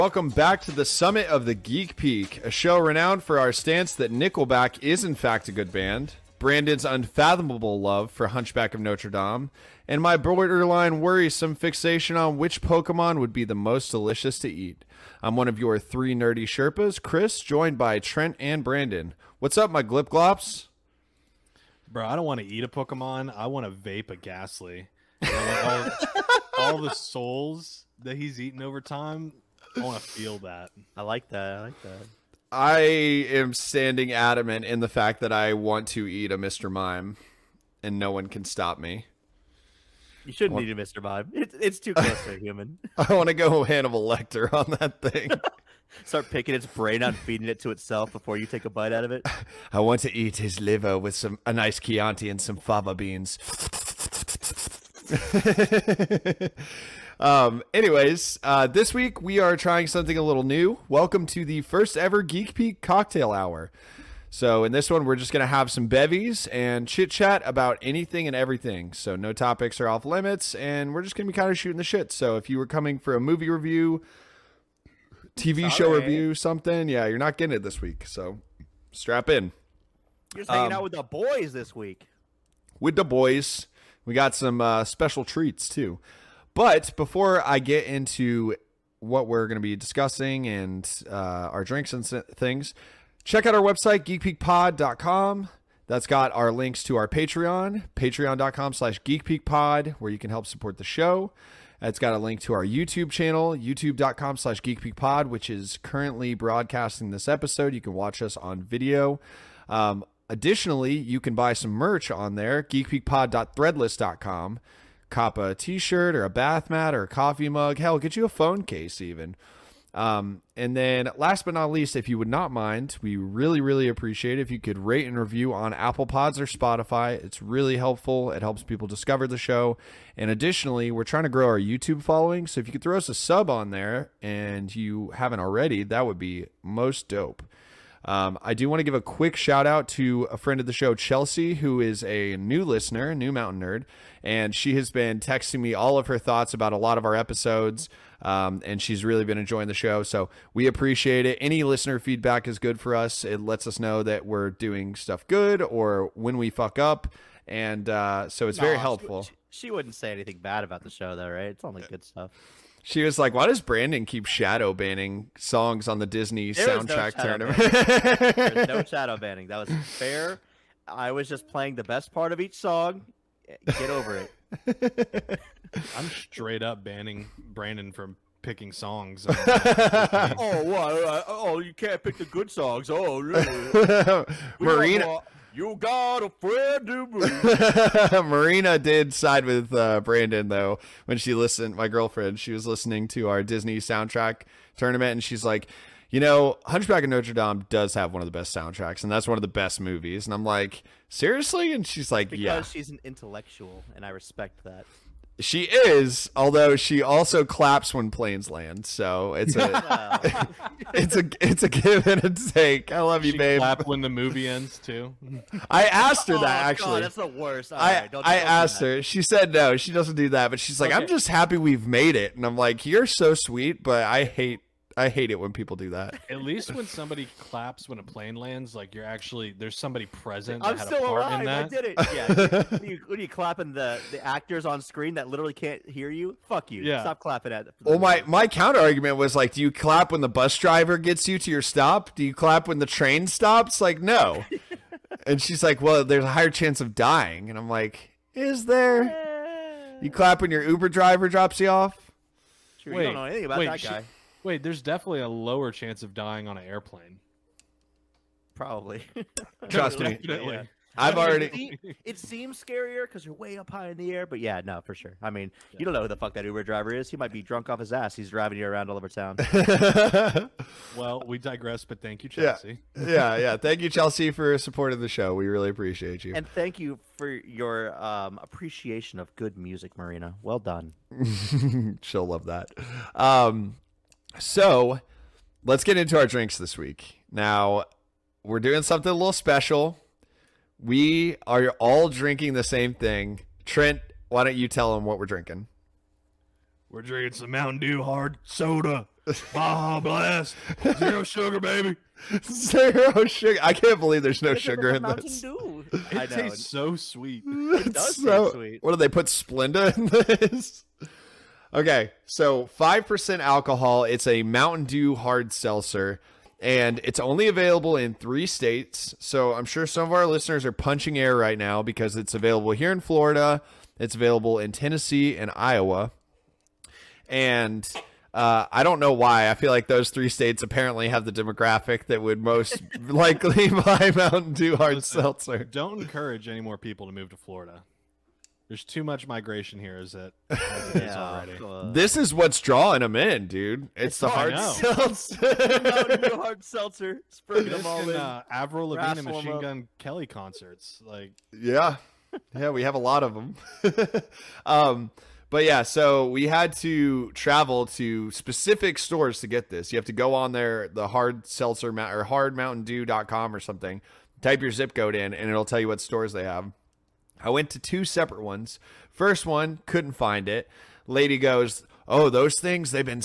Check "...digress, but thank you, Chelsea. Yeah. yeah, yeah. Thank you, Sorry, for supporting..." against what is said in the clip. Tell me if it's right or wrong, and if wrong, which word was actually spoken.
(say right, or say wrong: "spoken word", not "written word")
wrong: "Chelsea", not "Sorry".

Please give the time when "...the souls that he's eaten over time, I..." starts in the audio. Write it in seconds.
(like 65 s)
26 s.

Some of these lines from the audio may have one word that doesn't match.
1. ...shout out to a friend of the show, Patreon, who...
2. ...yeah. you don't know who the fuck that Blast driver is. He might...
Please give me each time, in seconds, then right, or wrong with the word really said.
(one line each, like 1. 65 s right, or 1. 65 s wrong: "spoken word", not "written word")
1. 139 s wrong: "Chelsea", not "Patreon"
2. 265 s wrong: "Uber", not "Blast".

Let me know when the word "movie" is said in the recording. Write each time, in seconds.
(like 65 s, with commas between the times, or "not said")
73 s, 199 s, 214 s.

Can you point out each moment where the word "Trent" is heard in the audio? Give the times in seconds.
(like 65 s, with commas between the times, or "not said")
17 s, 293 s.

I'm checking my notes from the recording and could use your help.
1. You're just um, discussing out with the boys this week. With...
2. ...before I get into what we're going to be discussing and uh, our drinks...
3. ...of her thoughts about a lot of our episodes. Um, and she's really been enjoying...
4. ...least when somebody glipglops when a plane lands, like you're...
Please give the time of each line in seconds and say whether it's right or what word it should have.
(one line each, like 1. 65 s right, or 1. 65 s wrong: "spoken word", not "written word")
1. 80 s wrong: "hanging", not "discussing"
2. 86 s right
3. 145 s right
4. 226 s wrong: "claps", not "glipglops".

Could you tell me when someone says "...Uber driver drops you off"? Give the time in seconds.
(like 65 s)
250 s.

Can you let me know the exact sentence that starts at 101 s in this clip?
It's got a link to our YouTube channel, youtube.com slash geekpeakpod, which is currently broadcasting this episode.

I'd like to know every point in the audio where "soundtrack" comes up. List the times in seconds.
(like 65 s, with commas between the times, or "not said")
166 s, 193 s, 198 s.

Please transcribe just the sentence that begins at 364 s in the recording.
Type your zip code in, and it'll tell you what stores they have I went to two separate ones.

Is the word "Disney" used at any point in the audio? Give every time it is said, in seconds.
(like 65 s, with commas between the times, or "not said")
166 s, 193 s.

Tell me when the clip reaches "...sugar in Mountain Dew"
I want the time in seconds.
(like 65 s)
304 s.